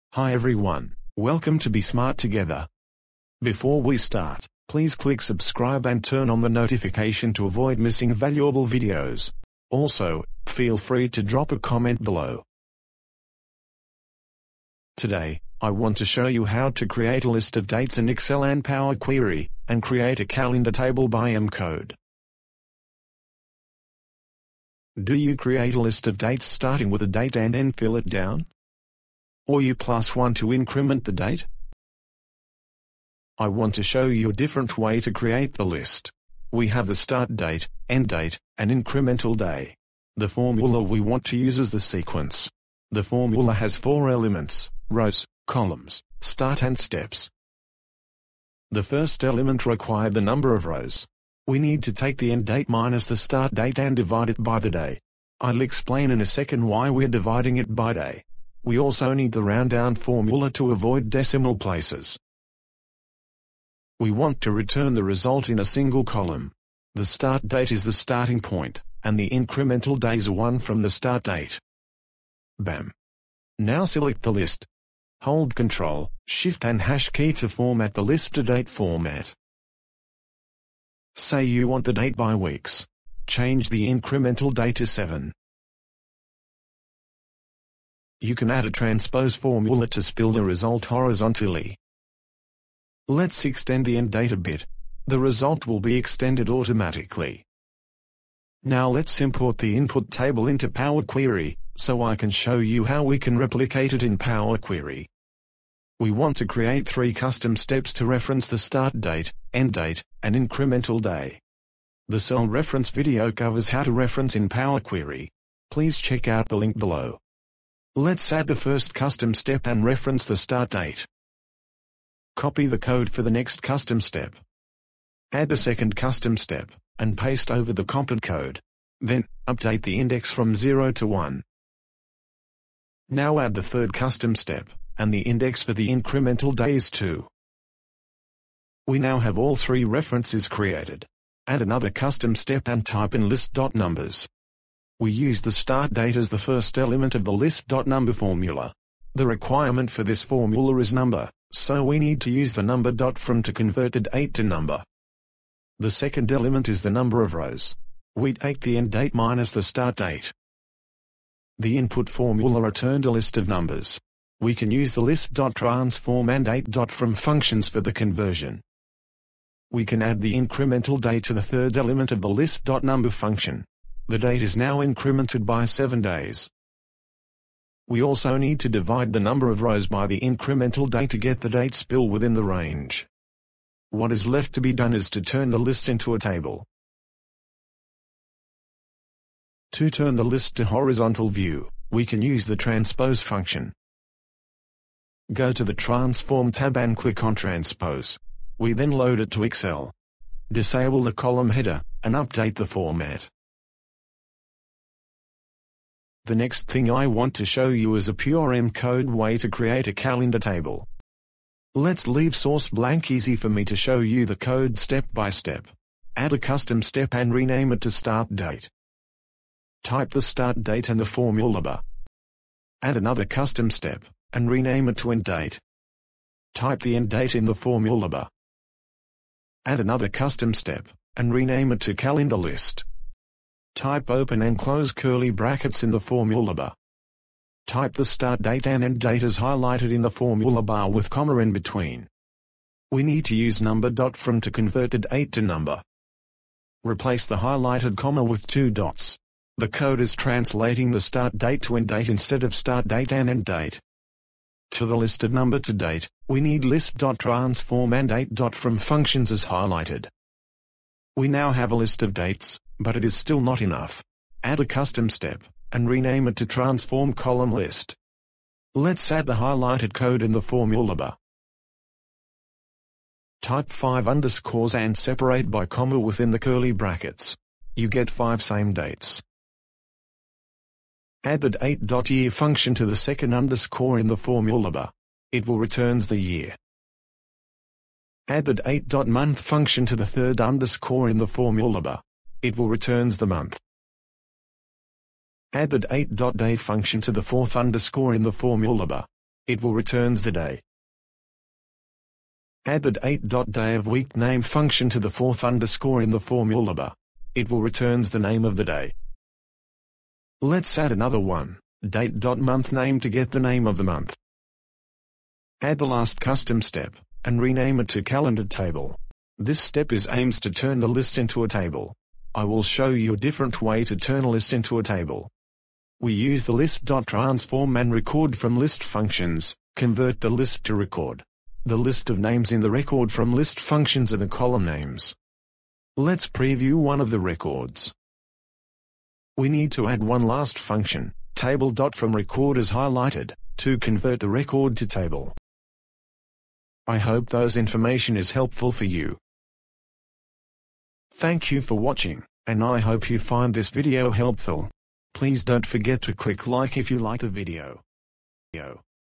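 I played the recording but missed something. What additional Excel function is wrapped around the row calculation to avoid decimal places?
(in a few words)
ROUNDDOWN.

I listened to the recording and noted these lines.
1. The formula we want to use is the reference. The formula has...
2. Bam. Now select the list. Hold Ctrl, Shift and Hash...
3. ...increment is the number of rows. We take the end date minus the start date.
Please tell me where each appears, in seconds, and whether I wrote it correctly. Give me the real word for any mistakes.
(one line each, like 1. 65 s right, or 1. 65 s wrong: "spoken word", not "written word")
1. 40 s wrong: "sequence", not "reference"
2. 72 s right
3. 156 s wrong: "element", not "increment".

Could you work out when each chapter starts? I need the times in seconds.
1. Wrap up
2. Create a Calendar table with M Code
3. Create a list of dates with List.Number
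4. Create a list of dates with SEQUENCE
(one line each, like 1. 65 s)
1. 346 s
2. 206 s
3. 106 s
4. 40 s.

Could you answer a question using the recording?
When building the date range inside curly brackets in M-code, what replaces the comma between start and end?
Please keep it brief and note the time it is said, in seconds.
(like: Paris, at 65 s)
Two dots, at 248 s.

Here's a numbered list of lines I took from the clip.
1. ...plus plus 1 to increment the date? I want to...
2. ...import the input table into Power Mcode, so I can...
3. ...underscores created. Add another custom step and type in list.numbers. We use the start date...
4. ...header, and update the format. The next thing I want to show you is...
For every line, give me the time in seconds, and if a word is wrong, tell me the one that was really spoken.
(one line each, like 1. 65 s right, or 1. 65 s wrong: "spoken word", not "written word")
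1. 29 s right
2. 99 s wrong: "Query", not "Mcode"
3. 139 s wrong: "references", not "underscores"
4. 201 s right.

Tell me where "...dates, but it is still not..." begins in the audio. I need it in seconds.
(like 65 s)
262 s.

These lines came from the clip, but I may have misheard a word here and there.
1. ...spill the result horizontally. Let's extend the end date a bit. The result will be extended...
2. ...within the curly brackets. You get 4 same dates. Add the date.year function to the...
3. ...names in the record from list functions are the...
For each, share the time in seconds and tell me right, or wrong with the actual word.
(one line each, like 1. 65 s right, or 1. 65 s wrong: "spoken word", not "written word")
1. 90 s right
2. 275 s wrong: "5", not "4"
3. 332 s right.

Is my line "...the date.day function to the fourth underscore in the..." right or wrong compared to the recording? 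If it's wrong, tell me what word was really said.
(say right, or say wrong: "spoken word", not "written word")
right.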